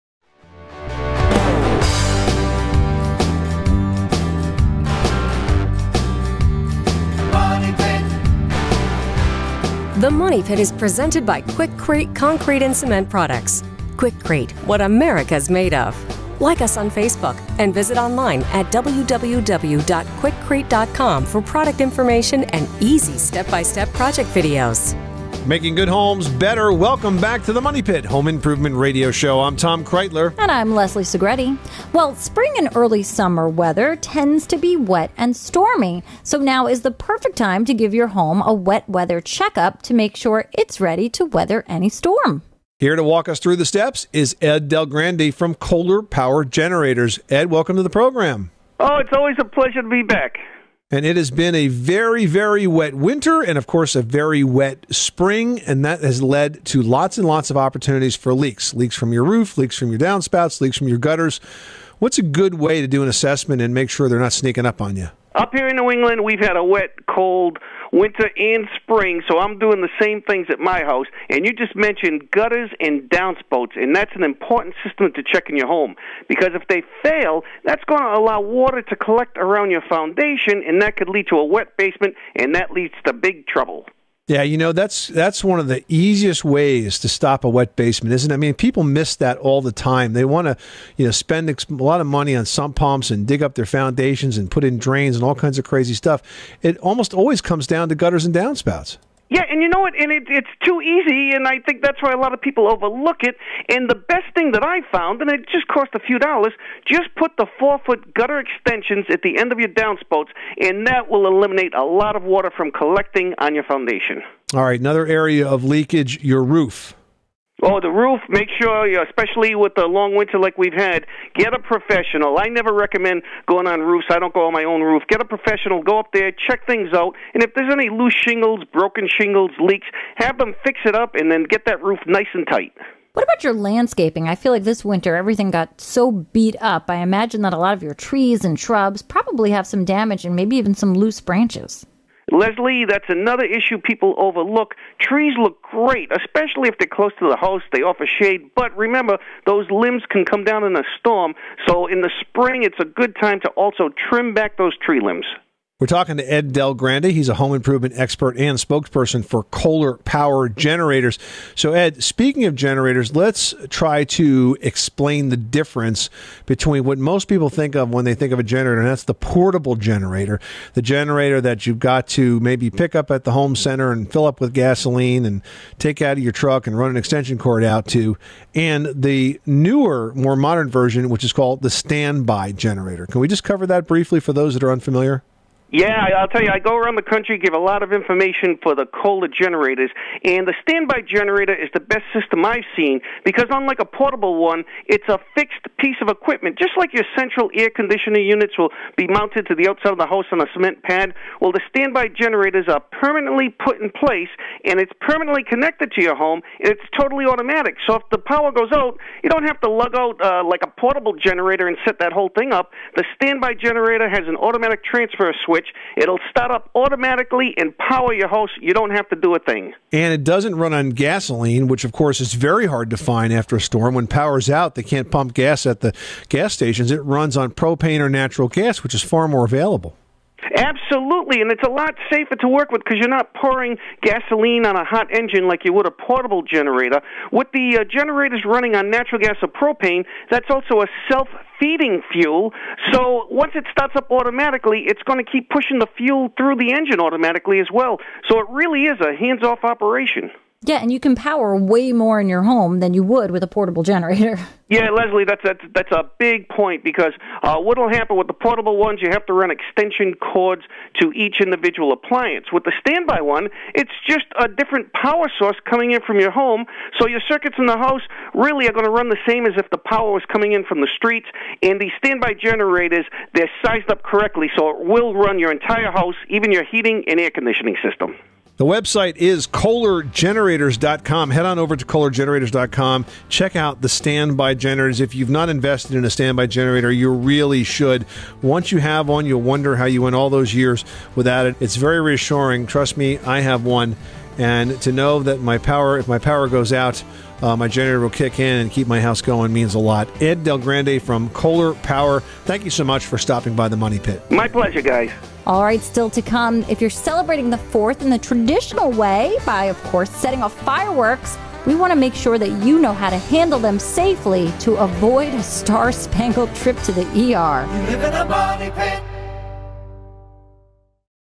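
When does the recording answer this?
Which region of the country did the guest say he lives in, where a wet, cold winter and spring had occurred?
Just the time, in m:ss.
1:05.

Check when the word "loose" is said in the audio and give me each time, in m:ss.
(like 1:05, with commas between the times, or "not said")
2:07, 2:20.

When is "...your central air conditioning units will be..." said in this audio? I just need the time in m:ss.
3:16.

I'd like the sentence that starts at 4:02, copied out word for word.
So once it starts up automatically, it's going to keep pushing the fuel through the engine automatically as well.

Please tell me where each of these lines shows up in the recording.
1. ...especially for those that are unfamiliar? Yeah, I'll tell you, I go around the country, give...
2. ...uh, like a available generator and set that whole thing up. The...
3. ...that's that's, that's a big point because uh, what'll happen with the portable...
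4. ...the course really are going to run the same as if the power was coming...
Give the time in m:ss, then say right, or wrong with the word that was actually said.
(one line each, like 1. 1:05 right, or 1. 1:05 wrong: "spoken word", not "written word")
1. 3:03 wrong: "briefly", not "especially"
2. 3:30 wrong: "portable", not "available"
3. 4:15 right
4. 4:27 wrong: "house", not "course".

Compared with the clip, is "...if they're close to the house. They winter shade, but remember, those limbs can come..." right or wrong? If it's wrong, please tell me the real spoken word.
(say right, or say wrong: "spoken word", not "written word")
wrong: "offer", not "winter".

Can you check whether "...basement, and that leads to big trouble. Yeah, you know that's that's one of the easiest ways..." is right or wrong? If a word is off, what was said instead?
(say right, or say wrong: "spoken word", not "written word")
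right.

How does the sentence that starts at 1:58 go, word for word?
Make sure, especially with the long winter like we've had, get a professional.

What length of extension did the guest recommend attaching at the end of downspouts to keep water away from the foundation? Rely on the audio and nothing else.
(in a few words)
4 foot.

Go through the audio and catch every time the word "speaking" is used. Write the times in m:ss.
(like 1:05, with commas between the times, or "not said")
2:42.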